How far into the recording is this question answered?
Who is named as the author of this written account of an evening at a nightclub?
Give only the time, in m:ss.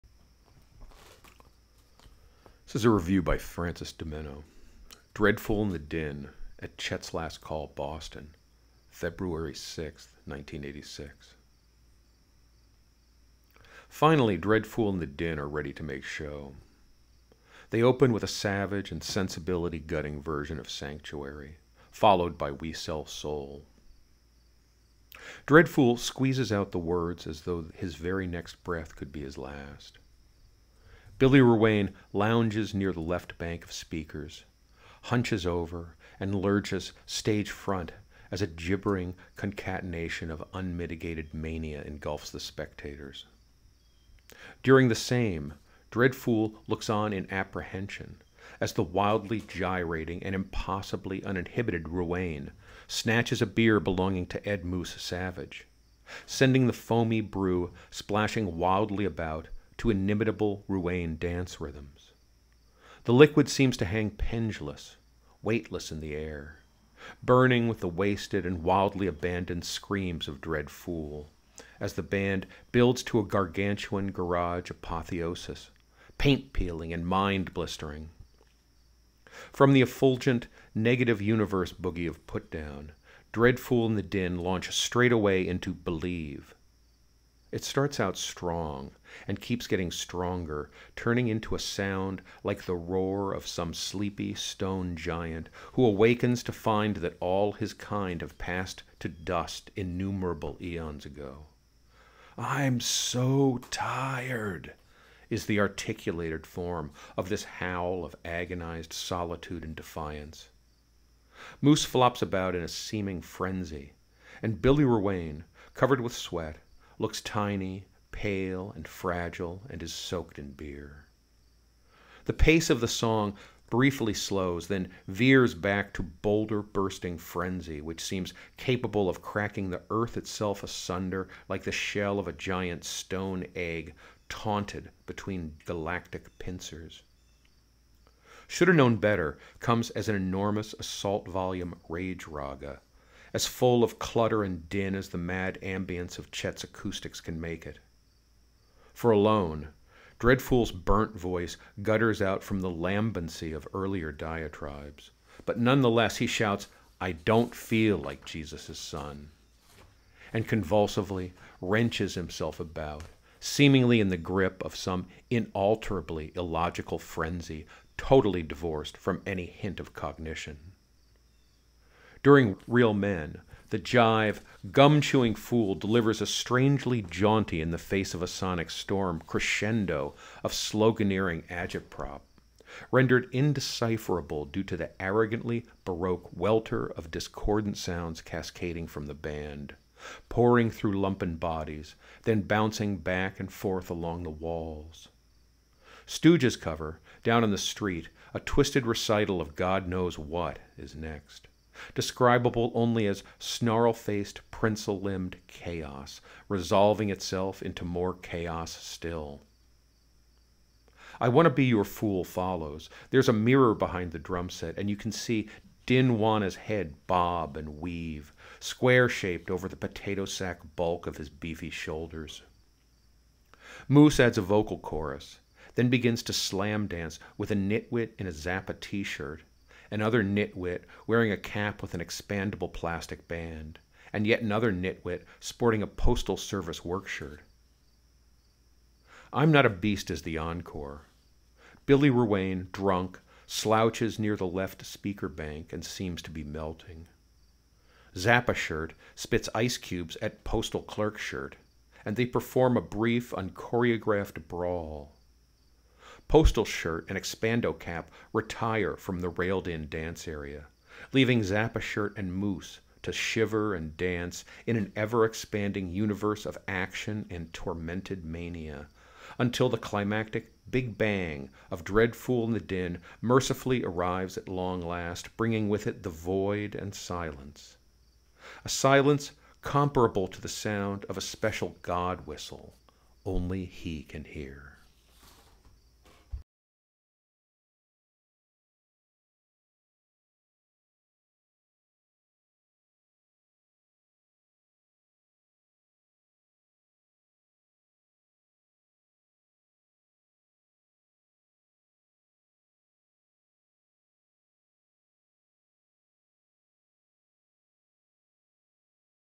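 0:03.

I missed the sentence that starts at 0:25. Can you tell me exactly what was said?
Dredd Foole squeezes out the words as though his very next breath could be his last.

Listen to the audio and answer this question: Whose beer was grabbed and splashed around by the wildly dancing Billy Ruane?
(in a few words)
Ed Moose Savage.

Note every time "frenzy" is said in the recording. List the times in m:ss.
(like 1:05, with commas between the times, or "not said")
1:53, 2:07, 2:46.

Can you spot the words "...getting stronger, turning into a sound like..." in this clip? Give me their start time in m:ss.
1:29.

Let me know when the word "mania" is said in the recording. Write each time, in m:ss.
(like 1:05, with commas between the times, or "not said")
0:41, 4:28.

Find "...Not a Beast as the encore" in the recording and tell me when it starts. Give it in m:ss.
3:59.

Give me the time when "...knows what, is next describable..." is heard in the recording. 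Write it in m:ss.
3:19.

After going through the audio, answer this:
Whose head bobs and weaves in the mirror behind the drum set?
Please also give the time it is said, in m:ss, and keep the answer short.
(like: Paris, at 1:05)
Dinwana, at 3:35.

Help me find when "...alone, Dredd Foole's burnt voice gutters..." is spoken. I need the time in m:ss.
2:29.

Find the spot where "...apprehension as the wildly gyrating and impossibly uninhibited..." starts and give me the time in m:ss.
0:47.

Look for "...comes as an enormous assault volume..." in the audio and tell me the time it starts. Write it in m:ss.
2:19.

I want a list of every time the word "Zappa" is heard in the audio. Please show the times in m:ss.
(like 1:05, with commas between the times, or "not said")
3:48, 4:08, 4:21.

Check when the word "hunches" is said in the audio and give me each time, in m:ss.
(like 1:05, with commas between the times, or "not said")
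0:35.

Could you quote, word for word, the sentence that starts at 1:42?
I'm so tired, is the articulated form of this howl of agonized solitude and defiance.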